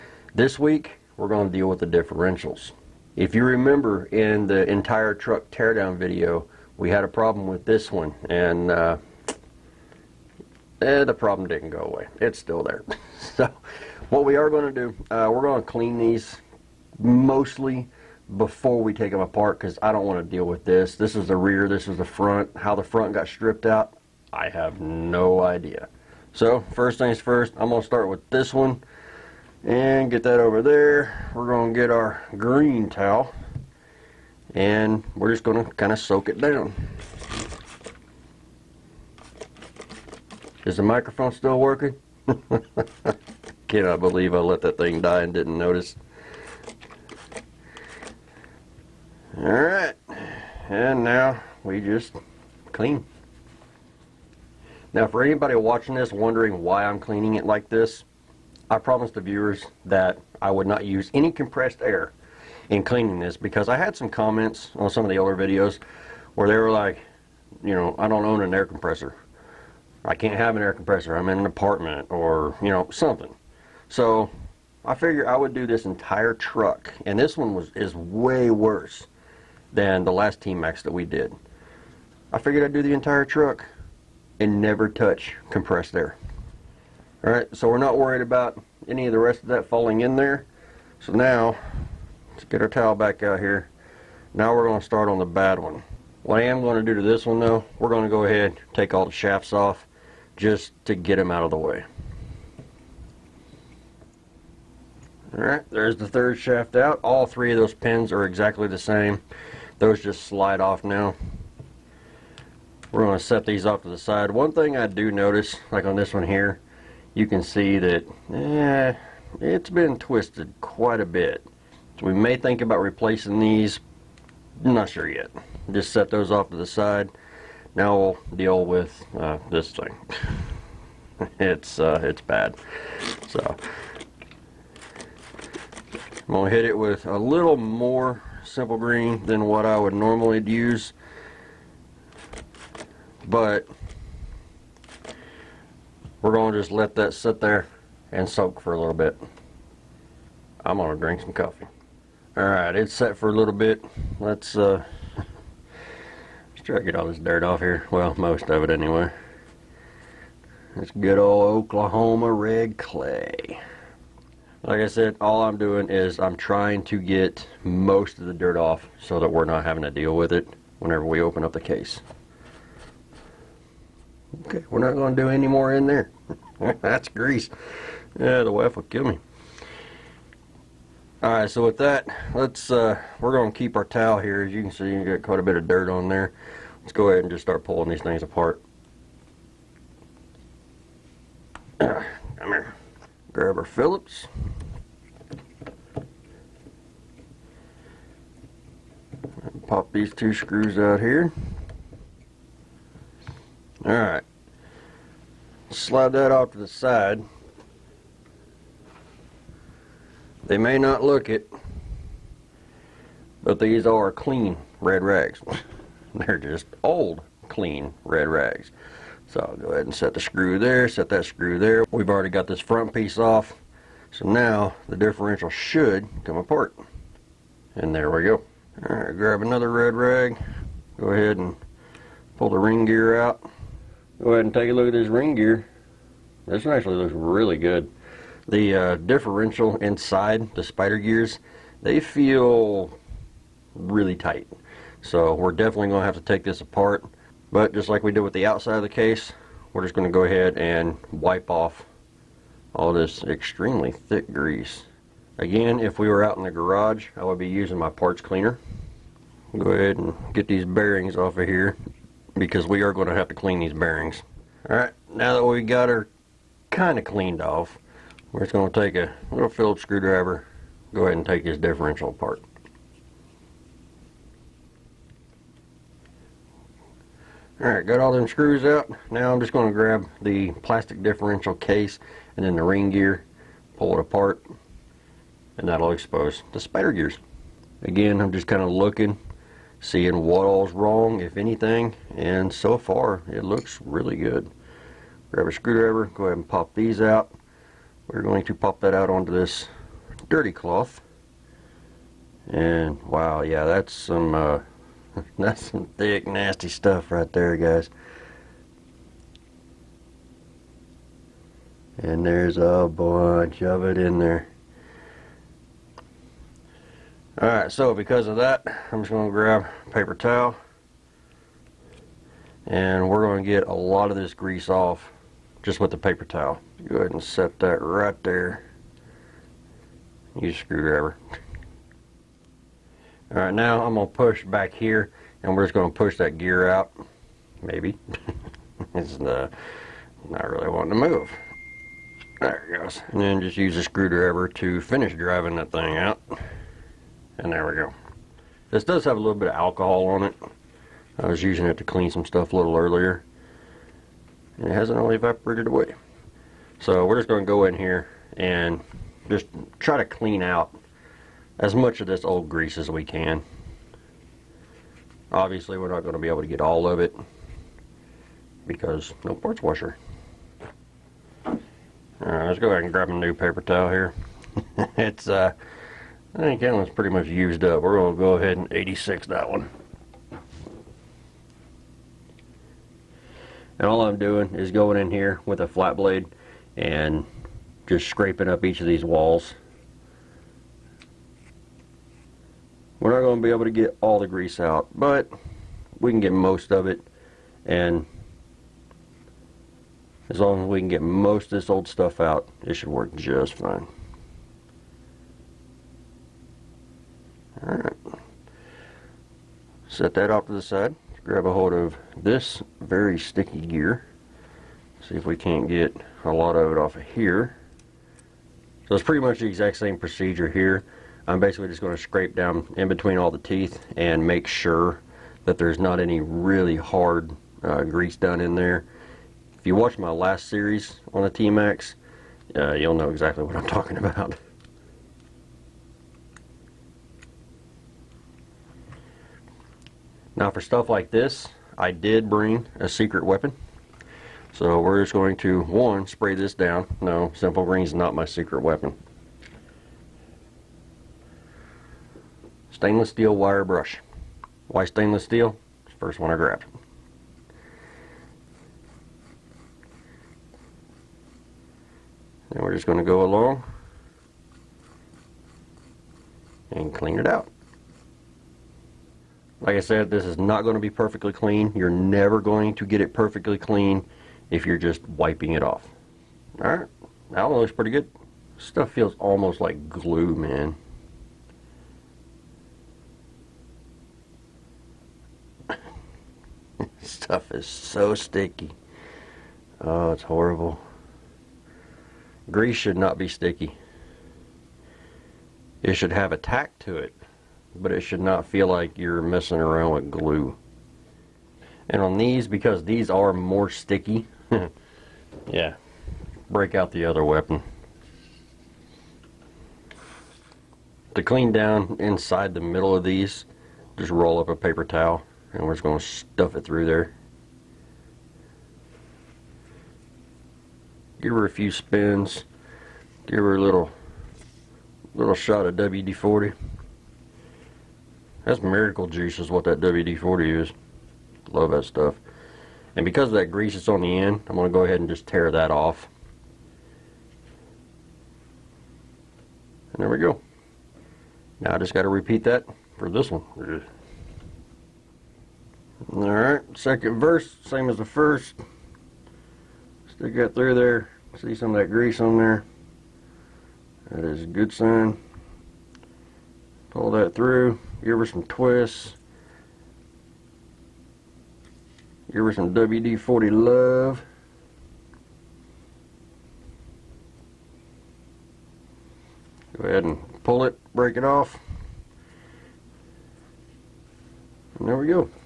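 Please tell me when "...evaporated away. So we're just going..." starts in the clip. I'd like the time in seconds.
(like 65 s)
355 s.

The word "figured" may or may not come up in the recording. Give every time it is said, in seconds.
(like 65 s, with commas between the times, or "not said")
74 s, 82 s.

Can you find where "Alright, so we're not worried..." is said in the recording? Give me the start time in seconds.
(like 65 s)
87 s.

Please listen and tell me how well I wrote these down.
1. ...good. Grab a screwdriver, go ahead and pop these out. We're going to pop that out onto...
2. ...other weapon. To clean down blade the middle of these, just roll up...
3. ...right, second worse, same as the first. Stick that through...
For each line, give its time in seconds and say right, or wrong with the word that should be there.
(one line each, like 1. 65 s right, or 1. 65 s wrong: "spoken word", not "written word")
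1. 294 s right
2. 507 s wrong: "inside", not "blade"
3. 546 s wrong: "verse", not "worse".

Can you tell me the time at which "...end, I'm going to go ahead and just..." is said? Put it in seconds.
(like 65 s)
534 s.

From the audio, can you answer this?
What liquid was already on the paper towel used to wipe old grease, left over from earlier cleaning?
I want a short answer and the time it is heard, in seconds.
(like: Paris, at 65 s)
alcohol, at 349 s.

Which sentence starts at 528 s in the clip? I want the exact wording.
That's miracle juice is what that WD-40 is.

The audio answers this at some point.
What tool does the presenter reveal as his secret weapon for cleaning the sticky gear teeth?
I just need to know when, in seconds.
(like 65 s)
452 s.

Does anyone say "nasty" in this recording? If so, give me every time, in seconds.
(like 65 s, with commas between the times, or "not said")
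306 s.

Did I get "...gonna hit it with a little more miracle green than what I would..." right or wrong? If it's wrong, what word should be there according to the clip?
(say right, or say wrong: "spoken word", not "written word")
wrong: "simple", not "miracle".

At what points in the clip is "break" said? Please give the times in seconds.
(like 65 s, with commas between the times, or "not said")
506 s, 570 s.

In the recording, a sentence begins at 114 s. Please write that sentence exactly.
One thing I do notice, like on this one here, you can see that eh, it's been twisted quite a bit.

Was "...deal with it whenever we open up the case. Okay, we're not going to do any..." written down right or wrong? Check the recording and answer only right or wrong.
right.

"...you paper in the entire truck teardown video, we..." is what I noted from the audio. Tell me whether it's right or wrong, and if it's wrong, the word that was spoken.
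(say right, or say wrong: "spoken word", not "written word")
wrong: "remember", not "paper".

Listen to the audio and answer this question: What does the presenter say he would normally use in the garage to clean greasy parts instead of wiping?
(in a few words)
parts cleaner.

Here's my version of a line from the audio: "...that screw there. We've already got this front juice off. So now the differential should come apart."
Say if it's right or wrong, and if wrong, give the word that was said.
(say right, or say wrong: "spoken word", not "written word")
wrong: "piece", not "juice".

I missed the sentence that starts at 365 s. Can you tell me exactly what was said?
Obviously we're not going to be able to get all of it because no parts washer.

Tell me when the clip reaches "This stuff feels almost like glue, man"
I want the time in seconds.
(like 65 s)
478 s.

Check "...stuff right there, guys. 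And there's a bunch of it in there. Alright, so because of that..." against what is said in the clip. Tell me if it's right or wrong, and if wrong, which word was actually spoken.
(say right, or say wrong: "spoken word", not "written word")
right.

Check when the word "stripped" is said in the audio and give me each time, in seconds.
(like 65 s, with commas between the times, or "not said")
23 s.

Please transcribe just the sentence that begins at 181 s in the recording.
Alright, so with that, let's uh, we're going to keep our towel here.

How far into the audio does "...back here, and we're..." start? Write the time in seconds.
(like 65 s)
334 s.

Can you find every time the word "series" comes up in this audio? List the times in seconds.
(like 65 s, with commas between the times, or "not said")
430 s.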